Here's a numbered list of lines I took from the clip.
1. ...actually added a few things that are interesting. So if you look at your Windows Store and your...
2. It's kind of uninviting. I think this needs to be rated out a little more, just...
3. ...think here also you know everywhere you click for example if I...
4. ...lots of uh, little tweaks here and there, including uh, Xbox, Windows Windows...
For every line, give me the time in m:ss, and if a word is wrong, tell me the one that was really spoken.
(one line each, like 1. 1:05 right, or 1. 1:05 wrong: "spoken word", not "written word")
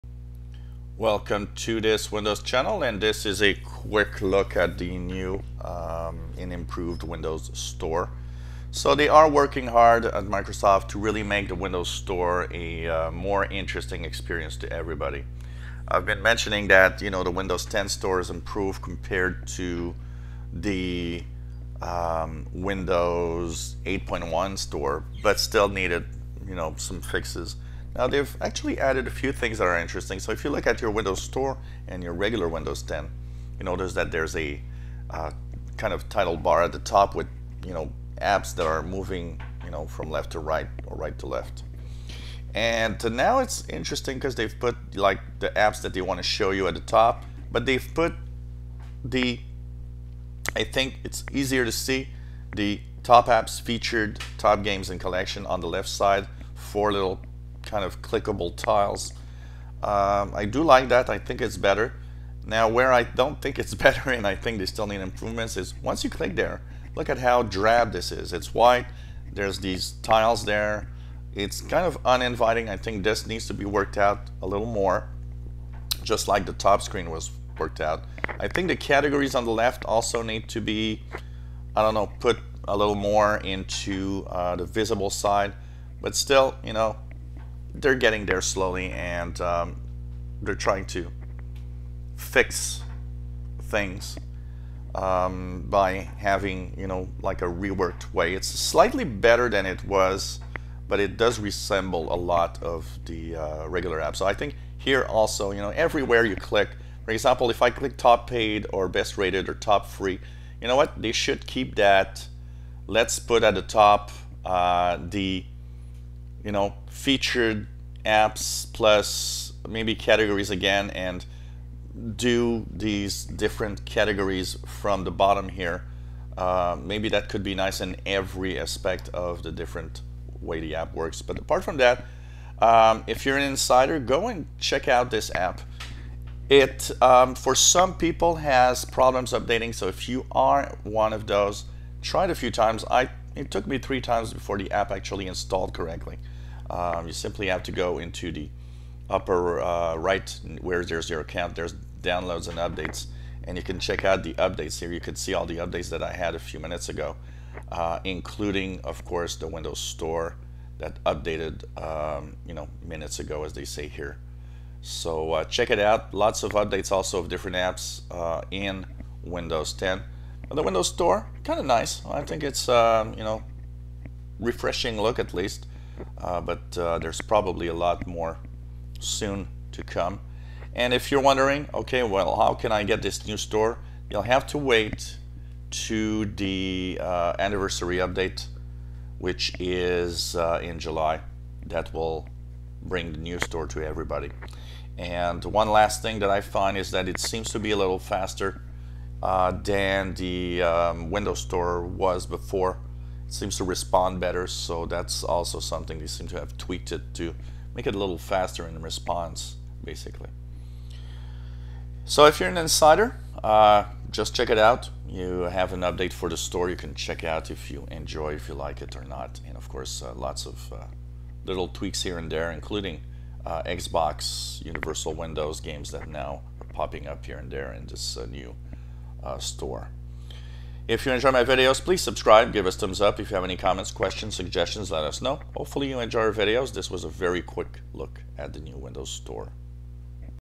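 1. 0:28 right
2. 1:11 wrong: "worked", not "rated"
3. 1:44 right
4. 3:40 wrong: "Universal", not "Windows".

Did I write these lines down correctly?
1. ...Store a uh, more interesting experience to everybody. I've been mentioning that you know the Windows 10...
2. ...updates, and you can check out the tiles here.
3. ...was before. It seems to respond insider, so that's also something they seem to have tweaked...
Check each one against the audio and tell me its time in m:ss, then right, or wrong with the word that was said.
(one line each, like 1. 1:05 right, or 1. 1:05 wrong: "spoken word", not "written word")
1. 0:11 right
2. 2:32 wrong: "updates", not "tiles"
3. 3:21 wrong: "better", not "insider".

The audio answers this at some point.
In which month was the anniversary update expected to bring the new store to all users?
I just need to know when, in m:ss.
3:10.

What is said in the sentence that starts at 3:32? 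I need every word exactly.
So if you're an insider, uh, just check it out.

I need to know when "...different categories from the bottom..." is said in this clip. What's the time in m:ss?
2:03.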